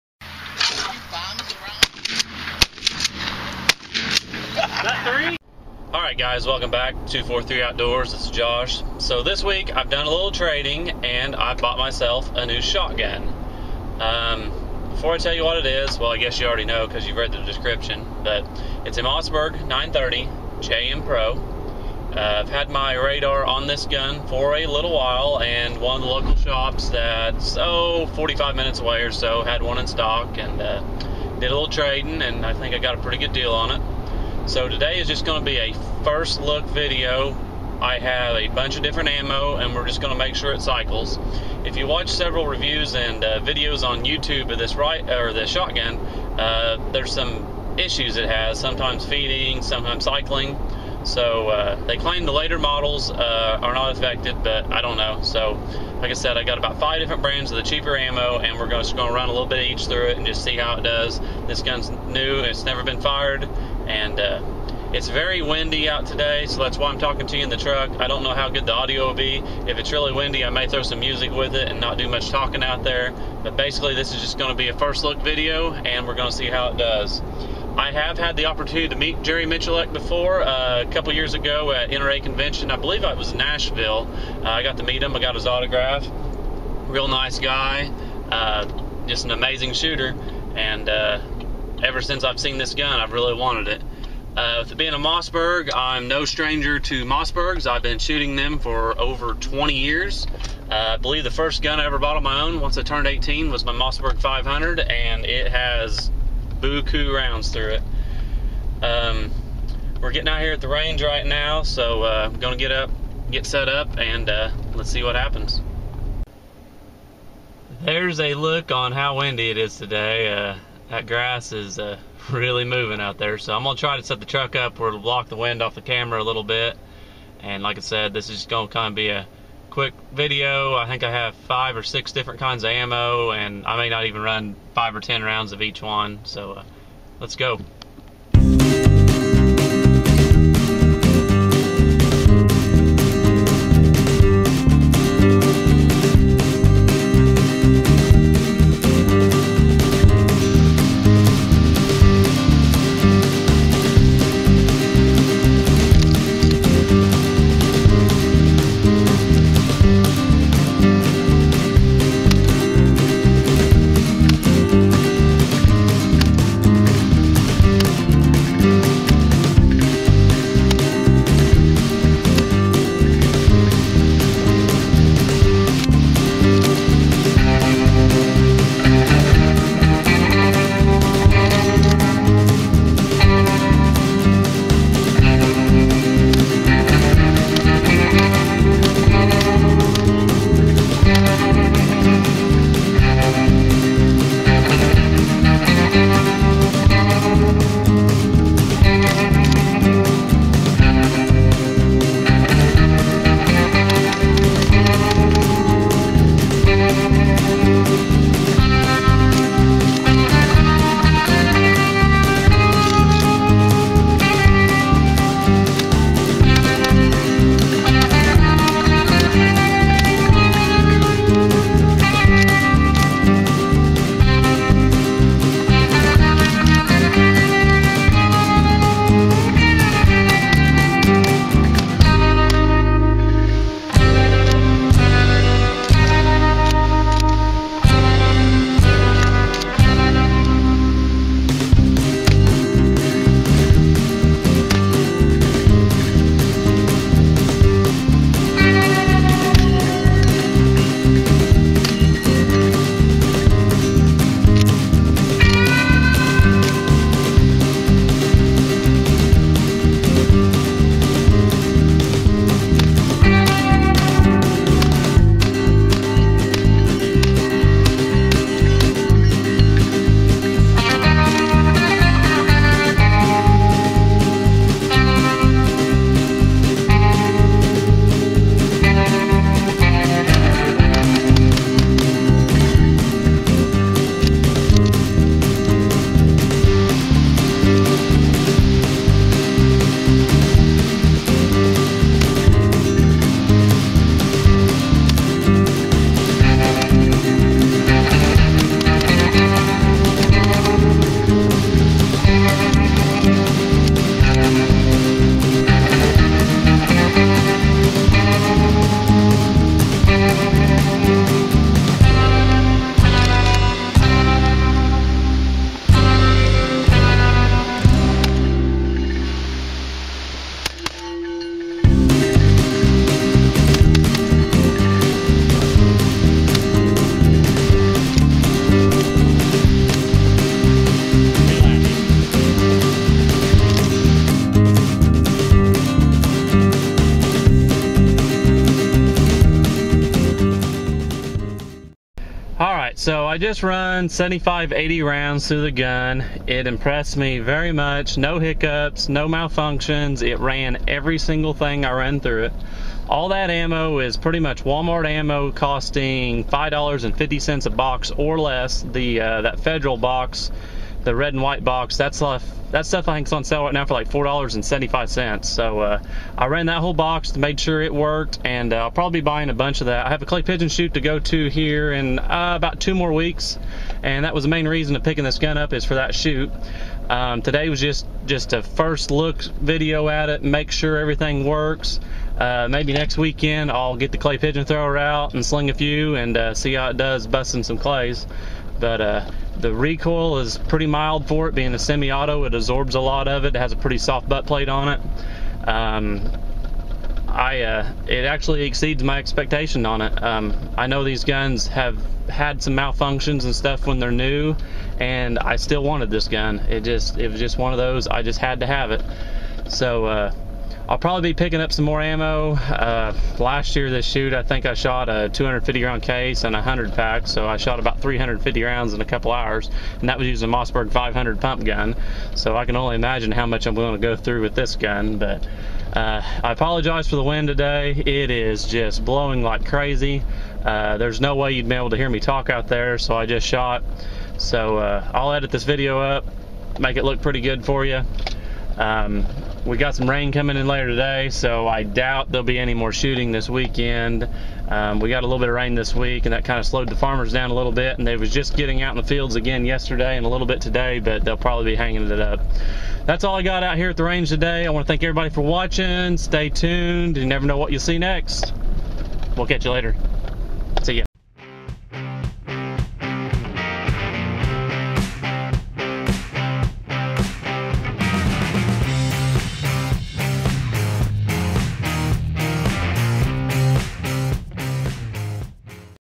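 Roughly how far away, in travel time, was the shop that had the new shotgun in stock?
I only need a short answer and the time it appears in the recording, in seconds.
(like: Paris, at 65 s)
45 minutes, at 28 s.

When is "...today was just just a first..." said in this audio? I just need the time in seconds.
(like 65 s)
377 s.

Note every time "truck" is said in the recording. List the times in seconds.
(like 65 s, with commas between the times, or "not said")
67 s, 124 s.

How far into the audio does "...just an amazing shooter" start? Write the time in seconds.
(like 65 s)
89 s.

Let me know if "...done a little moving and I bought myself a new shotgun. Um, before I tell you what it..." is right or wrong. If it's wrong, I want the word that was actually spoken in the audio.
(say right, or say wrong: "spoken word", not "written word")
wrong: "trading", not "moving".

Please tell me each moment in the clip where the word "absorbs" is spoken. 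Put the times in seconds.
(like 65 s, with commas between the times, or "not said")
392 s.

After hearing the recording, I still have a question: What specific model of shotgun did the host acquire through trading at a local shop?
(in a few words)
Mossberg 930 JM Pro.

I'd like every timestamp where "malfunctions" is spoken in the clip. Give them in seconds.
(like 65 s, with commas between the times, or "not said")
349 s, 402 s.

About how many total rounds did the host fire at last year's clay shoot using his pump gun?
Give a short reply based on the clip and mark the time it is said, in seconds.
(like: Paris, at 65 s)
350, at 418 s.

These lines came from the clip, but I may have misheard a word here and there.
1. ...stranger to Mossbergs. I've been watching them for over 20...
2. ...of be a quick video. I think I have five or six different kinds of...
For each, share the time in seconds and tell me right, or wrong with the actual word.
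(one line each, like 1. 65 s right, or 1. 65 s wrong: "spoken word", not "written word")
1. 96 s wrong: "shooting", not "watching"
2. 128 s right.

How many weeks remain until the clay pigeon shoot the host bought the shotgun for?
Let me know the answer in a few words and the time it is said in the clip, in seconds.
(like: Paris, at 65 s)
2, at 372 s.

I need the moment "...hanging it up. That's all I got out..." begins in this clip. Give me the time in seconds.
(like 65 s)
451 s.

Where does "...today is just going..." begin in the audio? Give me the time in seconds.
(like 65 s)
34 s.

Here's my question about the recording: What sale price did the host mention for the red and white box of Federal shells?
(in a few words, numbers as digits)
$4.75.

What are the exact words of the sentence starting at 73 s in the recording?
But basically, this is just going to be a first look video, and we're going to see how it does.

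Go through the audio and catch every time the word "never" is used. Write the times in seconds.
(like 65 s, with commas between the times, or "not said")
62 s, 457 s.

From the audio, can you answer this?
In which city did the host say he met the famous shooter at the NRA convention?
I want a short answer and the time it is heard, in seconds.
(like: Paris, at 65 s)
Nashville, at 83 s.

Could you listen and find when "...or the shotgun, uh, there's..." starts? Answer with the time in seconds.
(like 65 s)
45 s.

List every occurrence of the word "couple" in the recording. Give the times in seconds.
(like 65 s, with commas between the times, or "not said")
80 s, 419 s.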